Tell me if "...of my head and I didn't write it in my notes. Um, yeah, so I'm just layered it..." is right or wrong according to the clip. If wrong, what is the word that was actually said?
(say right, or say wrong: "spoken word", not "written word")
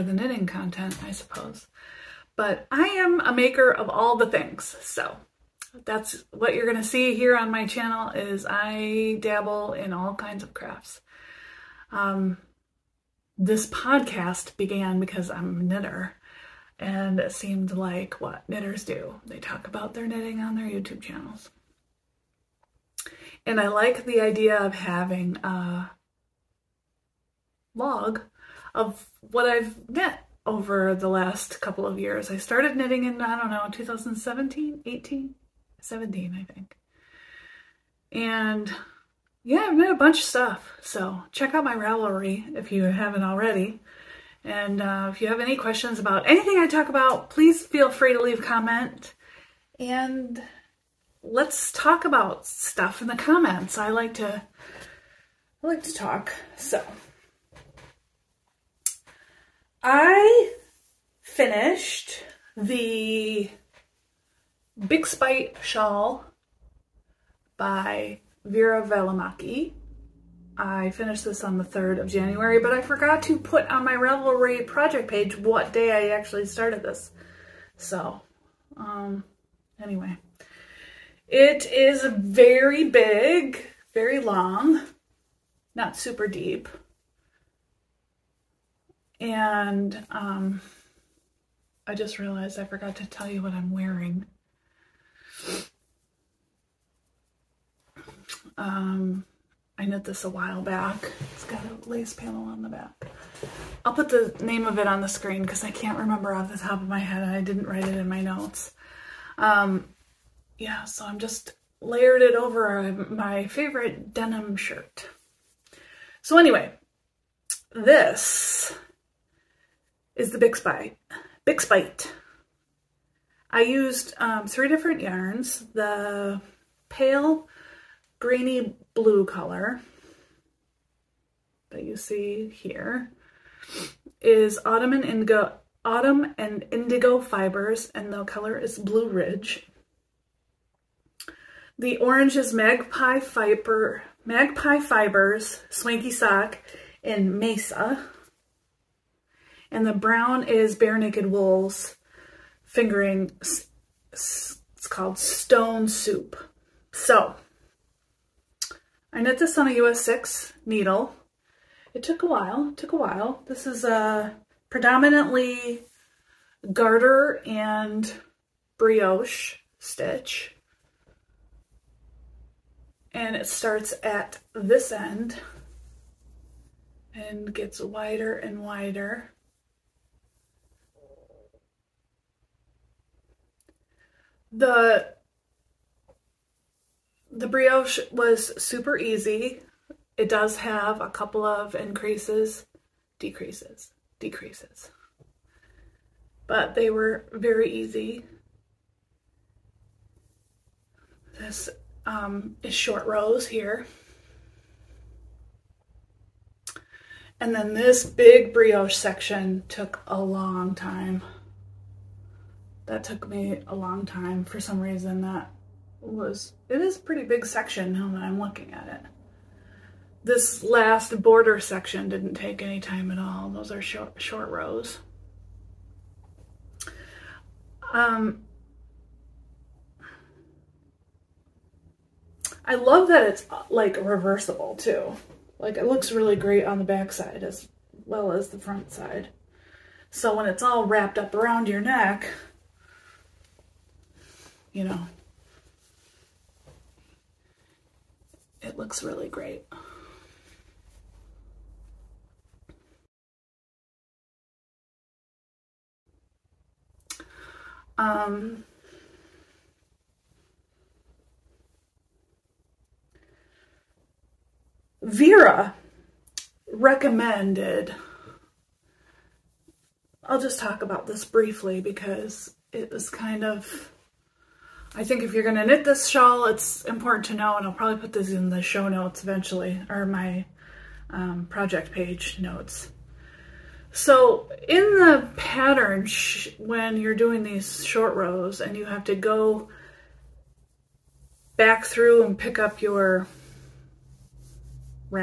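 right.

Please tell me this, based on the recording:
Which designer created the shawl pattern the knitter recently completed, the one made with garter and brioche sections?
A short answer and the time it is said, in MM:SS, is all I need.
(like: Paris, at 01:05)
Veera Valimaki, at 01:08.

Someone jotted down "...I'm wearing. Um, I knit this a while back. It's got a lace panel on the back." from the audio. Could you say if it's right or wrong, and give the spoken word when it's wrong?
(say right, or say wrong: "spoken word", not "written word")
right.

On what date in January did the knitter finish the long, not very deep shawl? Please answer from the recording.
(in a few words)
January 3.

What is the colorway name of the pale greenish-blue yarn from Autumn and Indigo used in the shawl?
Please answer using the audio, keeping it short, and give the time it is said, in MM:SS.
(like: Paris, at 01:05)
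Blue Ridge, at 02:18.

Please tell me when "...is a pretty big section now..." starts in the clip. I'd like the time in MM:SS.
03:36.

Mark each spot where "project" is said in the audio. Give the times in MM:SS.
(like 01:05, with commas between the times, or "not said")
01:14, 04:41.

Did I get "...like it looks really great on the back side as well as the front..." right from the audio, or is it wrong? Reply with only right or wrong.
right.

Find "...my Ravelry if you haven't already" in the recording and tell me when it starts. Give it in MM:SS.
00:41.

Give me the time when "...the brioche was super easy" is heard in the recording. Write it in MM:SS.
03:07.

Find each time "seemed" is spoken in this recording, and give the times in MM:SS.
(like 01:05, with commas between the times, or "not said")
00:17.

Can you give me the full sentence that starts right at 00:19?
They talk about their knitting on their YouTube channels.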